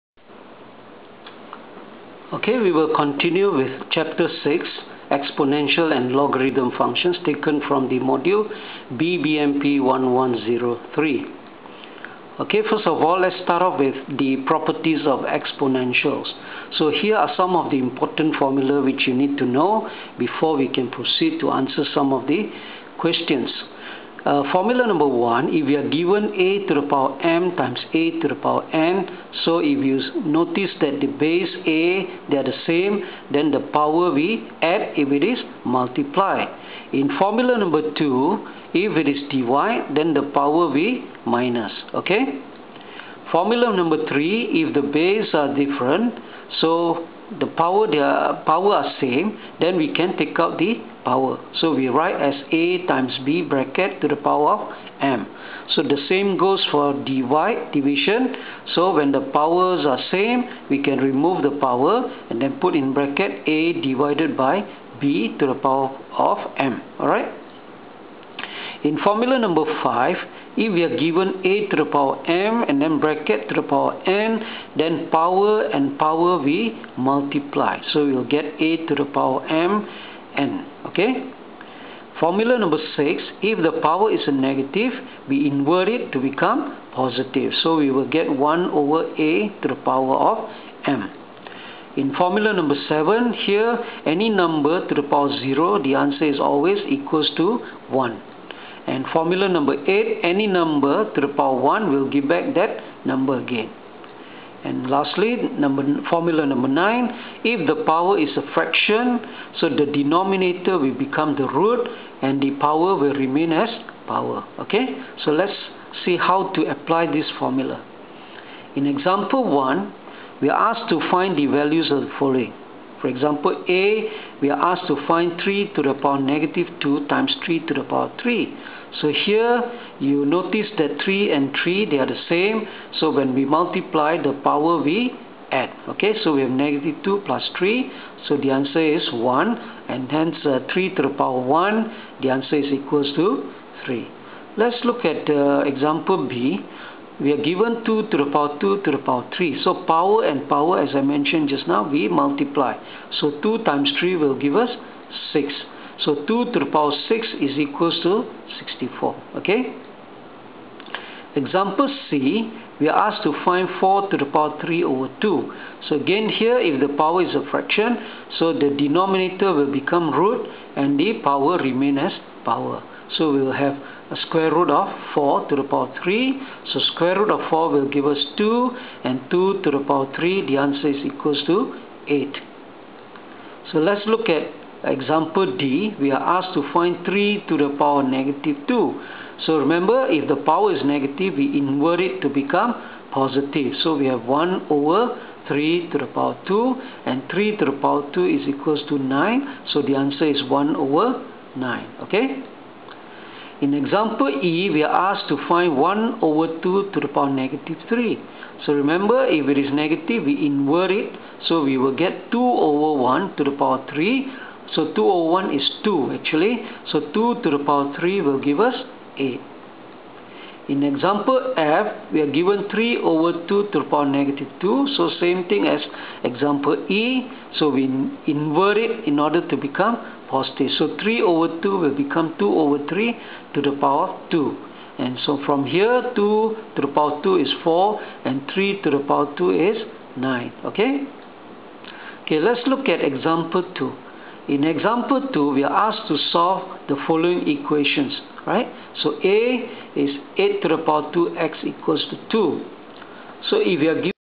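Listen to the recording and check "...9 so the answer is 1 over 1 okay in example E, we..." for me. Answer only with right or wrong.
wrong.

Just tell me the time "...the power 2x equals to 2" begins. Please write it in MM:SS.
04:10.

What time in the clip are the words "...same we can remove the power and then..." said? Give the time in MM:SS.
01:00.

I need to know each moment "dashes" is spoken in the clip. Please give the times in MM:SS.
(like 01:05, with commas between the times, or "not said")
not said.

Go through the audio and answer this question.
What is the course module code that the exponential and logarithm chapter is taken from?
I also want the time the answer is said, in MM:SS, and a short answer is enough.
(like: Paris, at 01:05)
BBMP 1103, at 00:08.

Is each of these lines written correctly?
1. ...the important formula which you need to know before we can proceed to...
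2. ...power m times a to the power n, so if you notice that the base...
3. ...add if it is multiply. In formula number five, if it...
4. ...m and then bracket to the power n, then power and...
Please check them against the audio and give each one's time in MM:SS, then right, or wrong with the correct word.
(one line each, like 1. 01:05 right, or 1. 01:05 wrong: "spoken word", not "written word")
1. 00:17 right
2. 00:26 right
3. 00:34 wrong: "two", not "five"
4. 01:12 right.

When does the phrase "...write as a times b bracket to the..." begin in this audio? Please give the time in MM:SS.
00:51.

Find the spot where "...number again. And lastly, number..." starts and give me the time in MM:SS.
01:43.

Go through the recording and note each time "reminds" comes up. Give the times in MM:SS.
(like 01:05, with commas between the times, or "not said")
not said.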